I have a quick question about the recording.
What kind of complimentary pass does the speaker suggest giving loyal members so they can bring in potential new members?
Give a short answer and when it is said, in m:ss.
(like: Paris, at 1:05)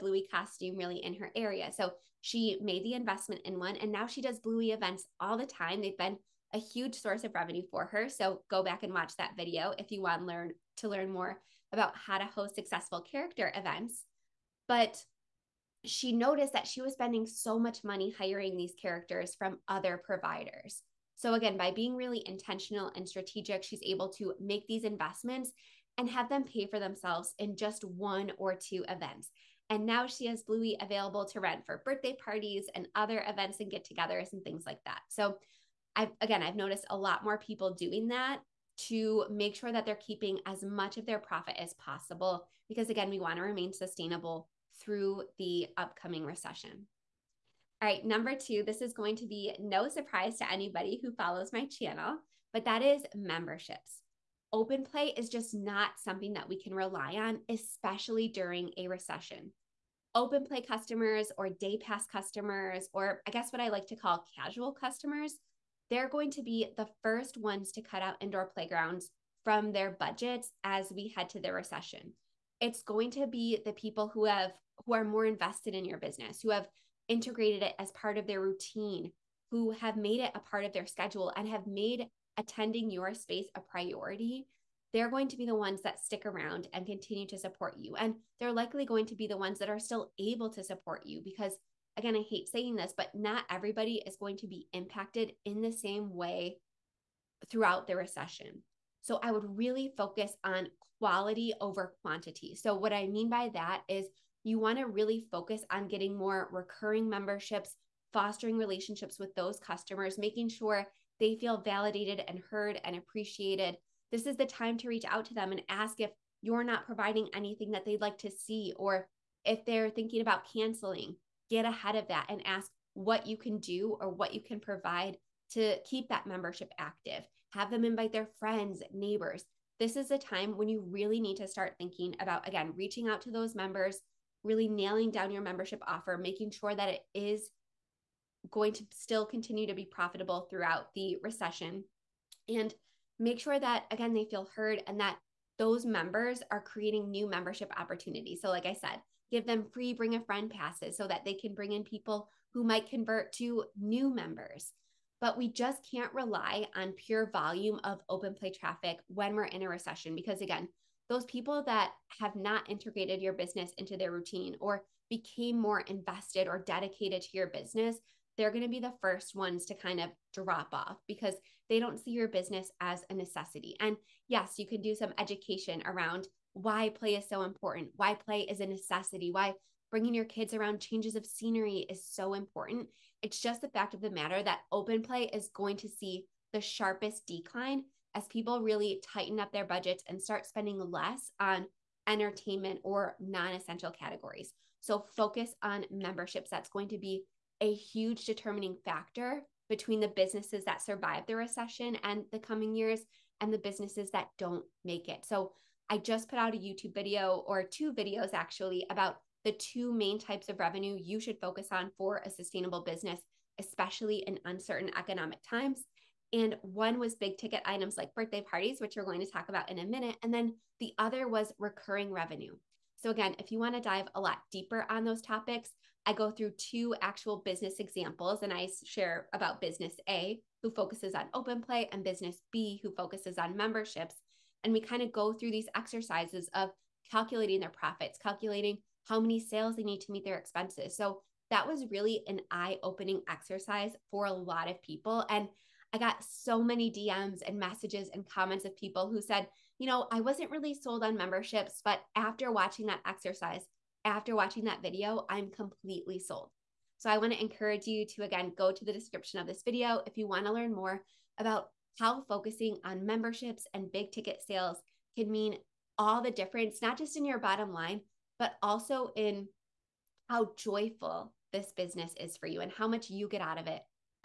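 free bring a friend passes, at 2:29.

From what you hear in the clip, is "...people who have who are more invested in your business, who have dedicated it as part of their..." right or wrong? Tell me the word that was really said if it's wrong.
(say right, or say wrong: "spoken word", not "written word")
wrong: "integrated", not "dedicated".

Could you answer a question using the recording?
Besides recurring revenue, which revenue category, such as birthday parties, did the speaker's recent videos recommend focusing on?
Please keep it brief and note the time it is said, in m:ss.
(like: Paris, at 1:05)
big ticket items, at 3:37.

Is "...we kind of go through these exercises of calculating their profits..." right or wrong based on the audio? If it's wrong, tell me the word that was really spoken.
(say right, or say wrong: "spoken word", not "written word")
right.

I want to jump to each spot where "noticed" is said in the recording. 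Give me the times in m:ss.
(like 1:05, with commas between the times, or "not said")
0:16, 0:36.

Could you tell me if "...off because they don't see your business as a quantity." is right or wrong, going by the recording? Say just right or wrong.
wrong.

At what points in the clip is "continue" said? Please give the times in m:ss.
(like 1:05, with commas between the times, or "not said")
1:26, 2:19.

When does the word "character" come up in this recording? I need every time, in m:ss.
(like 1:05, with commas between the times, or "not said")
0:13, 0:18.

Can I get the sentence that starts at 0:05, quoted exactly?
They've been a huge source of revenue for her.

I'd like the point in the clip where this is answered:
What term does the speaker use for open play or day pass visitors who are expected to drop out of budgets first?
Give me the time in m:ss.
1:04.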